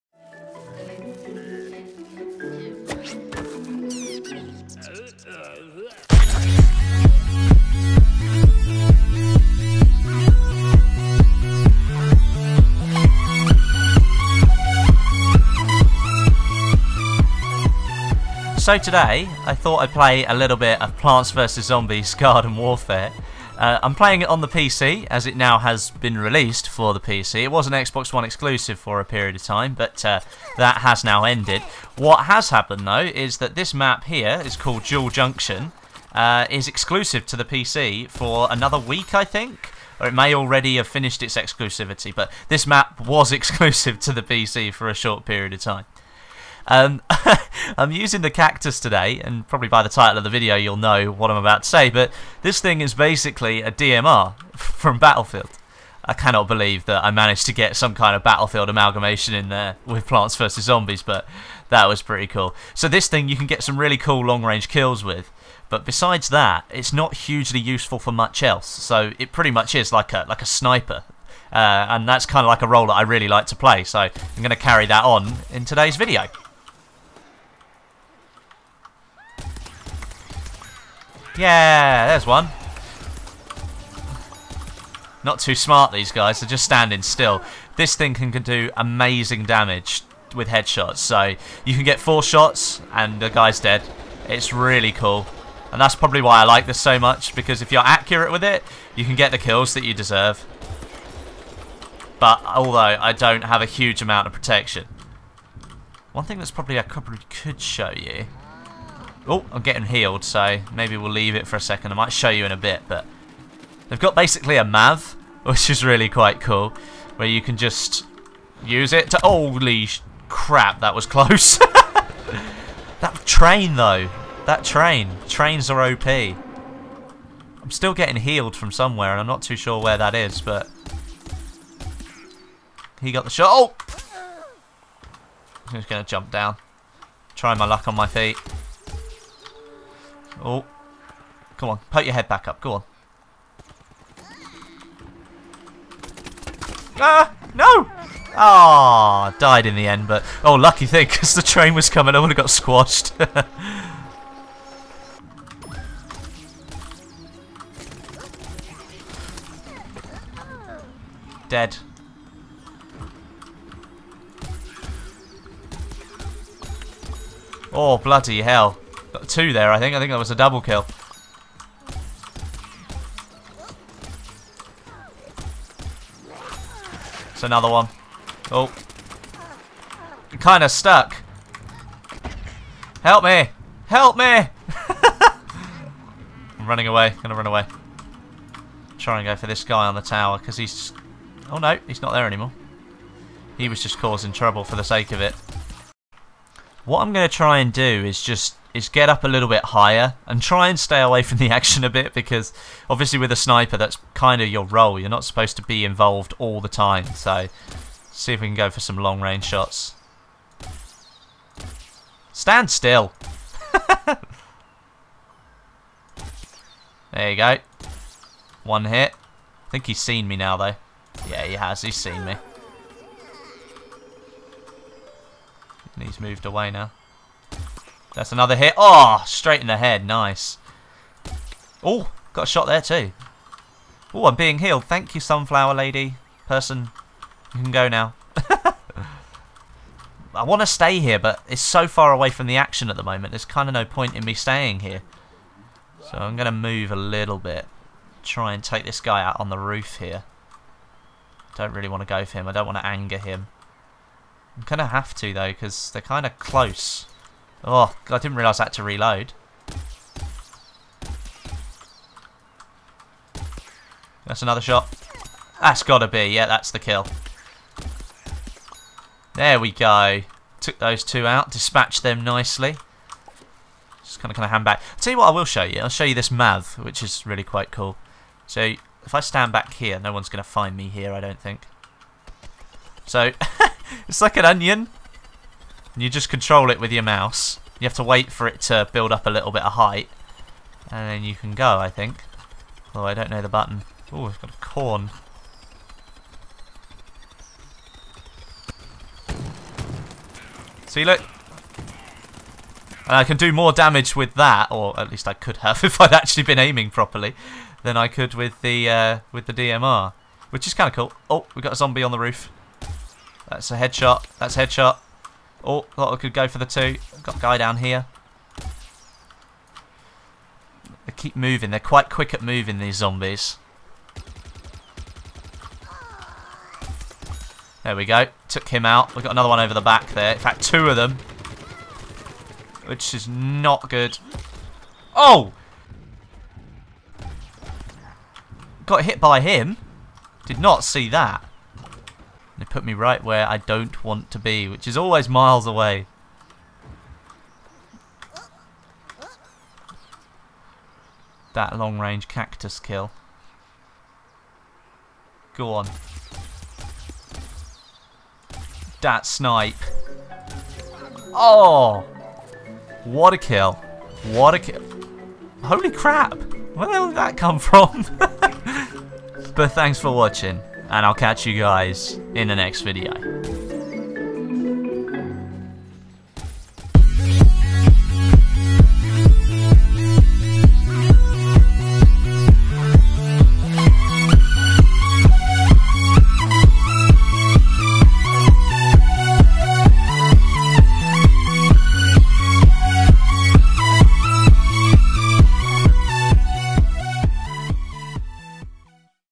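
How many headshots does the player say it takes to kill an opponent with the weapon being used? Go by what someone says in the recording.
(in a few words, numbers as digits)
4.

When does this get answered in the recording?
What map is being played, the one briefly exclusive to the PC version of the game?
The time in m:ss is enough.
0:34.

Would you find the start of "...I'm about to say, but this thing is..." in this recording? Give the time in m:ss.
0:51.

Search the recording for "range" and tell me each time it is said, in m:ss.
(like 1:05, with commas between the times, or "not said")
1:04, 3:29, 5:51.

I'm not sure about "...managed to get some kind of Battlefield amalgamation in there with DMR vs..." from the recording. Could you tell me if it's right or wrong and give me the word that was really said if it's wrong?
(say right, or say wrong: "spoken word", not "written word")
wrong: "Plants", not "DMR".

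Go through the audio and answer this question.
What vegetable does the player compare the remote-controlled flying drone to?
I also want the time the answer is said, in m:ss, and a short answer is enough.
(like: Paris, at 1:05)
onion, at 4:44.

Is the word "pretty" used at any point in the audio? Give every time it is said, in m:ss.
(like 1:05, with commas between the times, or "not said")
1:02, 1:09.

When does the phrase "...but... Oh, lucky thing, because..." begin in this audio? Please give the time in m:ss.
2:30.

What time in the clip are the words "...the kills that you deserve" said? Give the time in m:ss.
1:39.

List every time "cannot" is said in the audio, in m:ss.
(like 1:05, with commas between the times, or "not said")
0:56.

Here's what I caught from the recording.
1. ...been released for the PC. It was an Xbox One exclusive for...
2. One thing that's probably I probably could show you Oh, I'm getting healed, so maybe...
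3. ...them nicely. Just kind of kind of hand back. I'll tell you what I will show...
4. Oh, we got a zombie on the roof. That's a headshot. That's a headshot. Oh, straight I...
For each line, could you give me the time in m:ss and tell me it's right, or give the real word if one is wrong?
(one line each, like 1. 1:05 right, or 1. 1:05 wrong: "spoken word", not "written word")
1. 0:25 right
2. 1:46 right
3. 4:32 right
4. 5:11 wrong: "thought", not "straight".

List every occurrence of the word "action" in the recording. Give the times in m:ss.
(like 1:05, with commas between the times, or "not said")
3:21, 4:02.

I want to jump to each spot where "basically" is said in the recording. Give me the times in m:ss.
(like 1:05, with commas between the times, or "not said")
0:52, 1:54.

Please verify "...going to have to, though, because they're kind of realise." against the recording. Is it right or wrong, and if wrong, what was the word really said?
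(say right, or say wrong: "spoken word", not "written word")
wrong: "close", not "realise".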